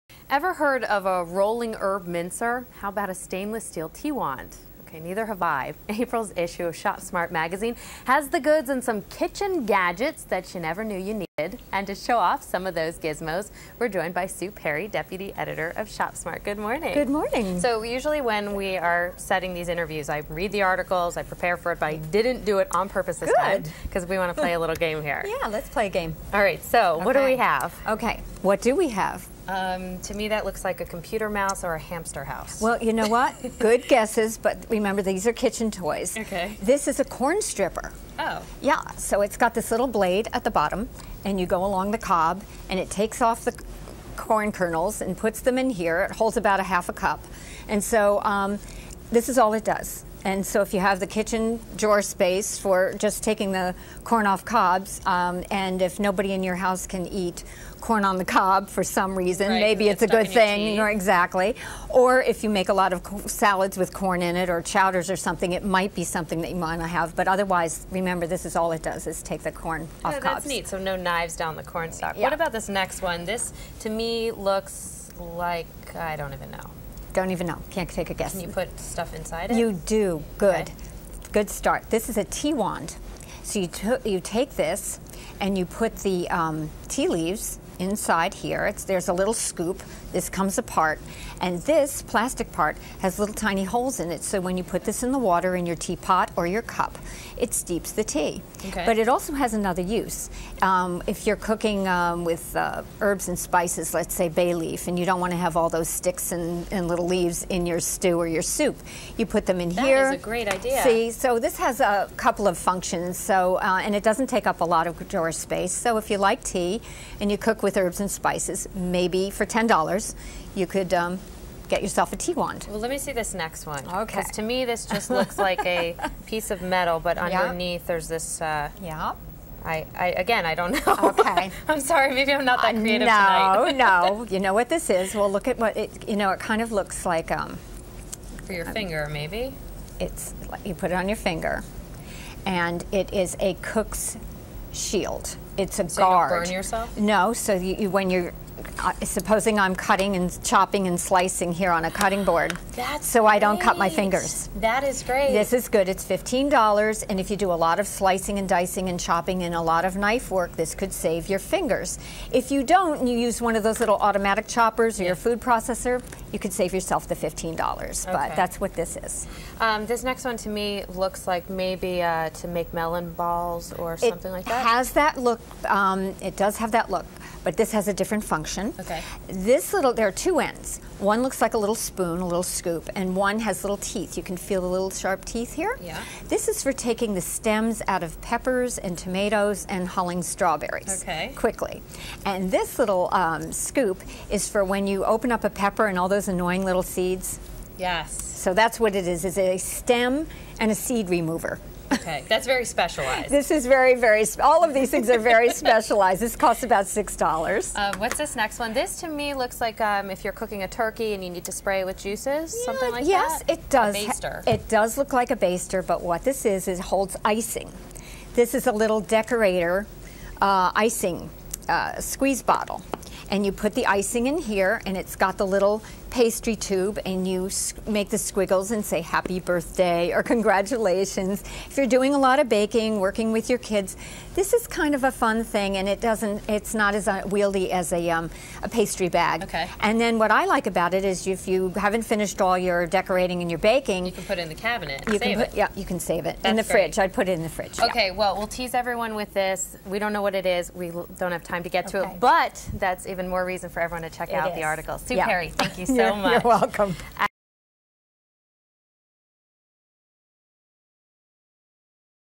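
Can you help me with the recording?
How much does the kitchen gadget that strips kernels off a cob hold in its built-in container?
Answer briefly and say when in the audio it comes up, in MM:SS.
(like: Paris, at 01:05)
half a cup, at 00:46.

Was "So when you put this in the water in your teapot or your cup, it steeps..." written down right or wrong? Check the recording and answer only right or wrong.
right.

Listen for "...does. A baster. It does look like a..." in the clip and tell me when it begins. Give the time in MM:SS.
03:33.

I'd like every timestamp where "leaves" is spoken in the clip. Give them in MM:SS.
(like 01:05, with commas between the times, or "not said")
01:27, 01:47.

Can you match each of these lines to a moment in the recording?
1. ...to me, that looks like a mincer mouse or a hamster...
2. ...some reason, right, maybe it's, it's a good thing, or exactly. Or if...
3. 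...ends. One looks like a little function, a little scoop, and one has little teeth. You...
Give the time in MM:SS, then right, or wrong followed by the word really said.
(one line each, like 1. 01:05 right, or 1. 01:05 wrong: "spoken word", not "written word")
1. 00:29 wrong: "computer", not "mincer"
2. 00:58 right
3. 03:00 wrong: "spoon", not "function".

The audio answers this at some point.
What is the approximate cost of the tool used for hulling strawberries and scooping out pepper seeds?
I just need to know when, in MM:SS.
03:26.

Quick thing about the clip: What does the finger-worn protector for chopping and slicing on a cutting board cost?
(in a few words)
$15.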